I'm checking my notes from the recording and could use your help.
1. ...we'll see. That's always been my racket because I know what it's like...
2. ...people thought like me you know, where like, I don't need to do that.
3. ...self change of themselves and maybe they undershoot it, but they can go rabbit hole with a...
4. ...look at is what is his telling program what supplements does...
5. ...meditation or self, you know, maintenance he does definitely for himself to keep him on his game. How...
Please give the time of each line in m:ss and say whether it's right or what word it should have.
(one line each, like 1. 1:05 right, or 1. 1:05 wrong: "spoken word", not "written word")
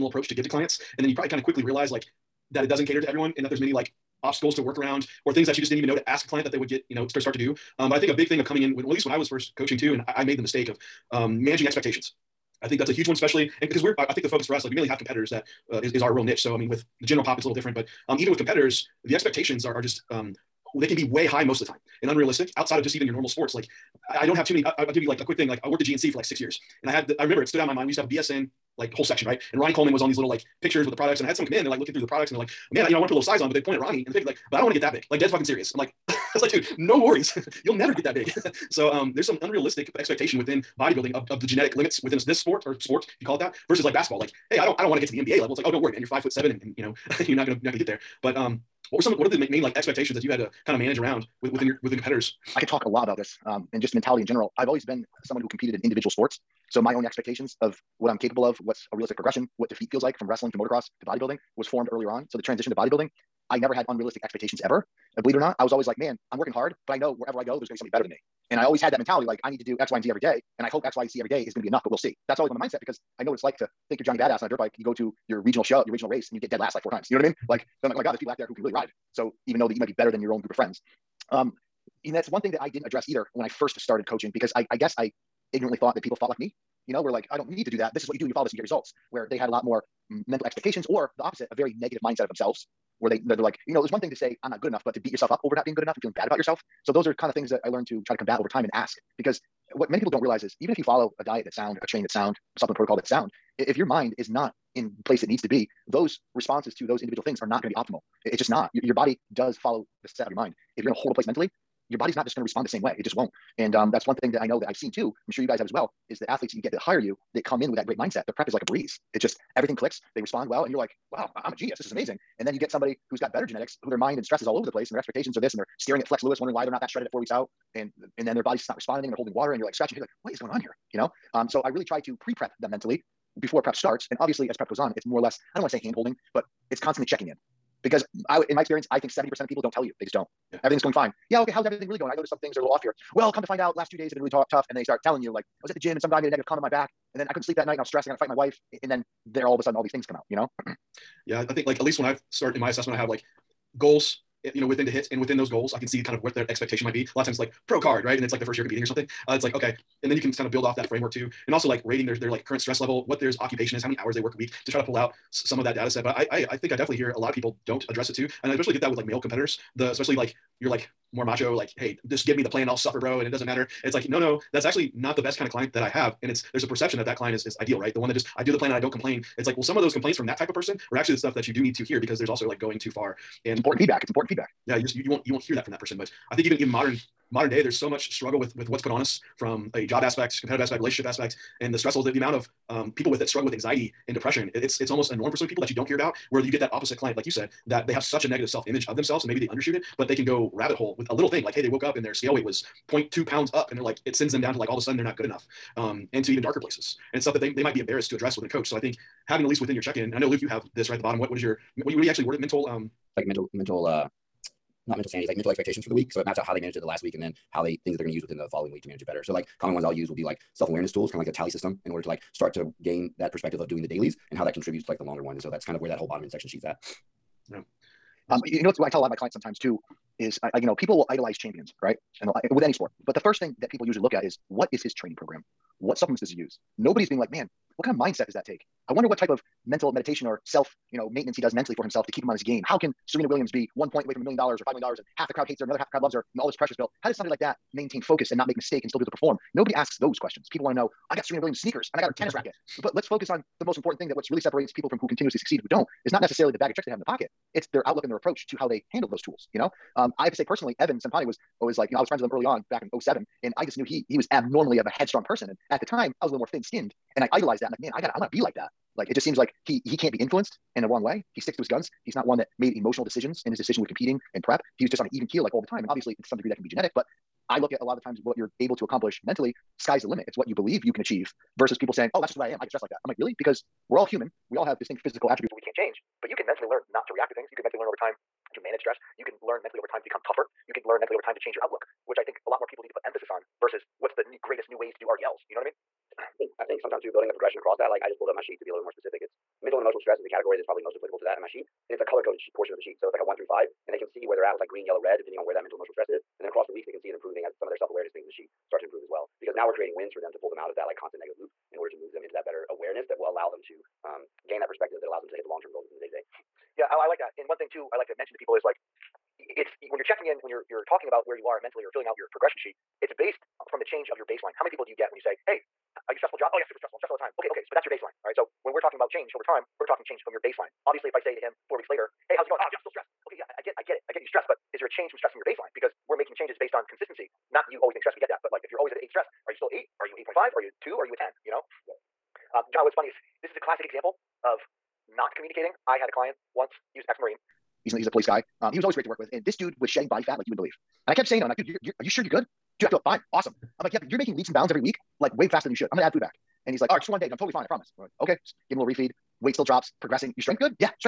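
1. 1:11 wrong: "mindset", not "racket"
2. 1:26 right
3. 3:18 wrong: "image", not "change"
4. 3:54 wrong: "training", not "telling"
5. 3:59 wrong: "mentally", not "definitely".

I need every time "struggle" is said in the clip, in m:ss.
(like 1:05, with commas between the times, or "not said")
3:08, 3:13.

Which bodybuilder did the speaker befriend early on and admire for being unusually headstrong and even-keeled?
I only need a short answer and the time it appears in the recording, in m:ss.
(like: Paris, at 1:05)
Evan Centopani, at 4:20.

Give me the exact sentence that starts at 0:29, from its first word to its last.
And Ronnie Coleman was on these little like pictures with the products.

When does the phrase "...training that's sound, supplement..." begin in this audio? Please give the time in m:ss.
1:41.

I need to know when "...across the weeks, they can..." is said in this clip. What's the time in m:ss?
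5:06.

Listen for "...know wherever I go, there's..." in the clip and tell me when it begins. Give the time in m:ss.
1:06.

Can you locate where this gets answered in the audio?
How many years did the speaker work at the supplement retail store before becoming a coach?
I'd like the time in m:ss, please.
0:26.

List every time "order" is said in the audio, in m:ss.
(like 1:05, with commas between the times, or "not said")
3:41, 5:11.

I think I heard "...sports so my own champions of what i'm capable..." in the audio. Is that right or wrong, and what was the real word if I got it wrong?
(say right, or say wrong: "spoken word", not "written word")
wrong: "expectations", not "champions".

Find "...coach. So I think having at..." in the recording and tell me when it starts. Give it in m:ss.
3:28.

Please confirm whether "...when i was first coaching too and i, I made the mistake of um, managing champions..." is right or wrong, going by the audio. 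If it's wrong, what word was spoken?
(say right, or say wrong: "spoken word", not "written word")
wrong: "expectations", not "champions".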